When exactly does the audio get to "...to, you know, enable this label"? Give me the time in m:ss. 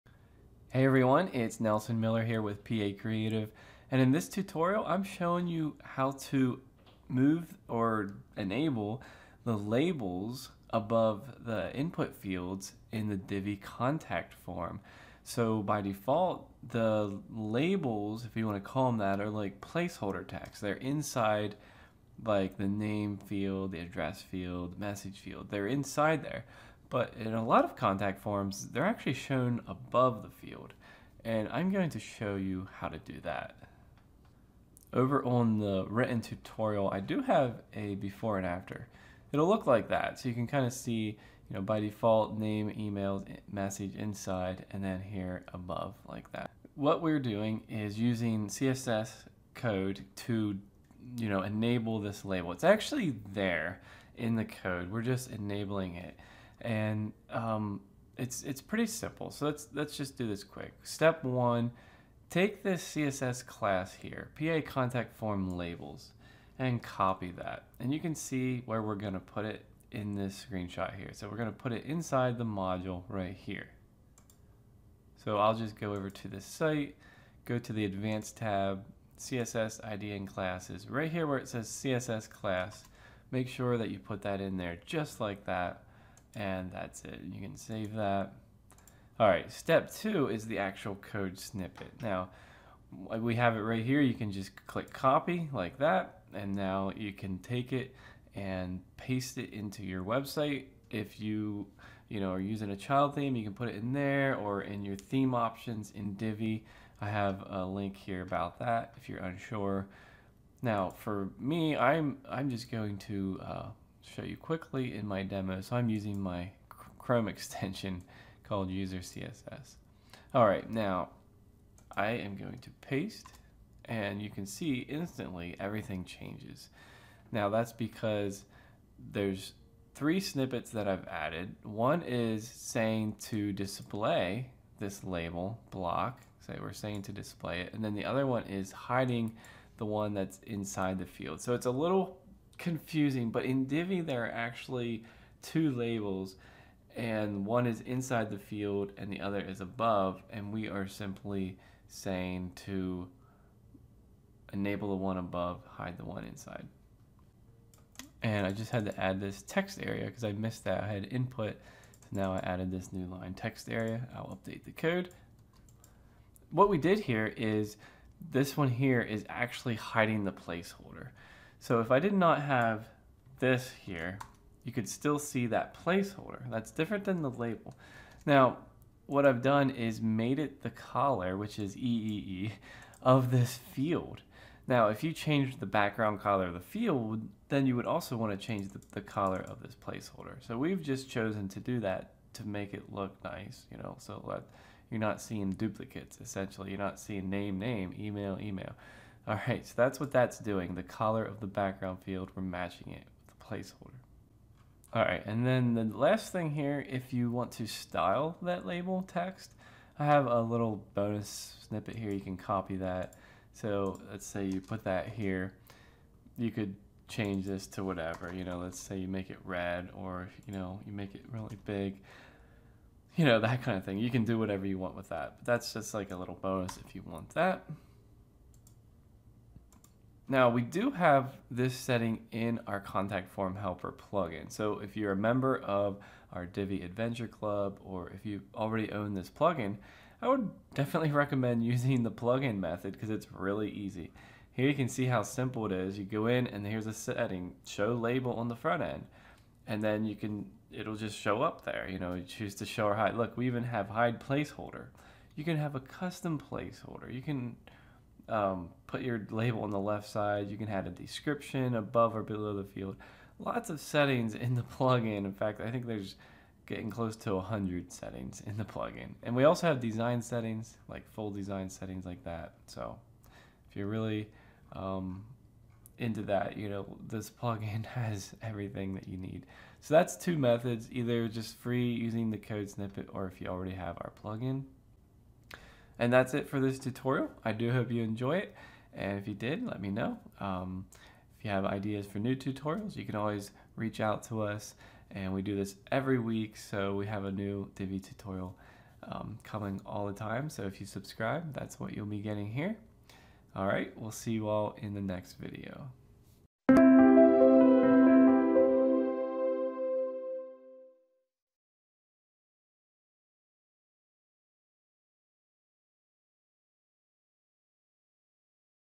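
0:50.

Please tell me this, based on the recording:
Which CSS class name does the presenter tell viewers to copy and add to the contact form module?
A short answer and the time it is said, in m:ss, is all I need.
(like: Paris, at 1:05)
PA contact form labels, at 1:04.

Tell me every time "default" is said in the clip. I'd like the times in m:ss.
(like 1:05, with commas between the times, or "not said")
0:15, 0:41.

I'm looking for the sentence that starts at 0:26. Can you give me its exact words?
But in a lot of contact forms, they're actually shown above the field.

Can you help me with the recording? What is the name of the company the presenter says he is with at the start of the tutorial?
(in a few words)
Pee-Aye Creative.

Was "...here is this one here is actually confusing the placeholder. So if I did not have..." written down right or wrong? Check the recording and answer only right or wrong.
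wrong.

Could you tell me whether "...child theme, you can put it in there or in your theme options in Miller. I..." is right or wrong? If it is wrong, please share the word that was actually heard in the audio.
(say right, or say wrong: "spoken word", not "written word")
wrong: "Divi", not "Miller".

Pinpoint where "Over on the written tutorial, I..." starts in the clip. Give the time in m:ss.
0:34.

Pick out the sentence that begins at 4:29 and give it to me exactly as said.
And we also have design settings, like full design settings like that.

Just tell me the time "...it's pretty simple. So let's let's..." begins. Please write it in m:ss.
0:58.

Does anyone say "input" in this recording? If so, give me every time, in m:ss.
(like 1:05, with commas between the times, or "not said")
0:11, 2:41.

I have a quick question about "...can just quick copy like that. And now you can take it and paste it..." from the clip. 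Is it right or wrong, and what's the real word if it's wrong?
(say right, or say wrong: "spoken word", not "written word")
wrong: "click", not "quick".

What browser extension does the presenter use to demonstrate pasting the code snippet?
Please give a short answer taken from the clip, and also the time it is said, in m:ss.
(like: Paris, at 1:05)
User CSS, at 1:58.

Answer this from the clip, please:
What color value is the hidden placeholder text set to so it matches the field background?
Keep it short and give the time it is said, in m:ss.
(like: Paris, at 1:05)
EEE, at 3:01.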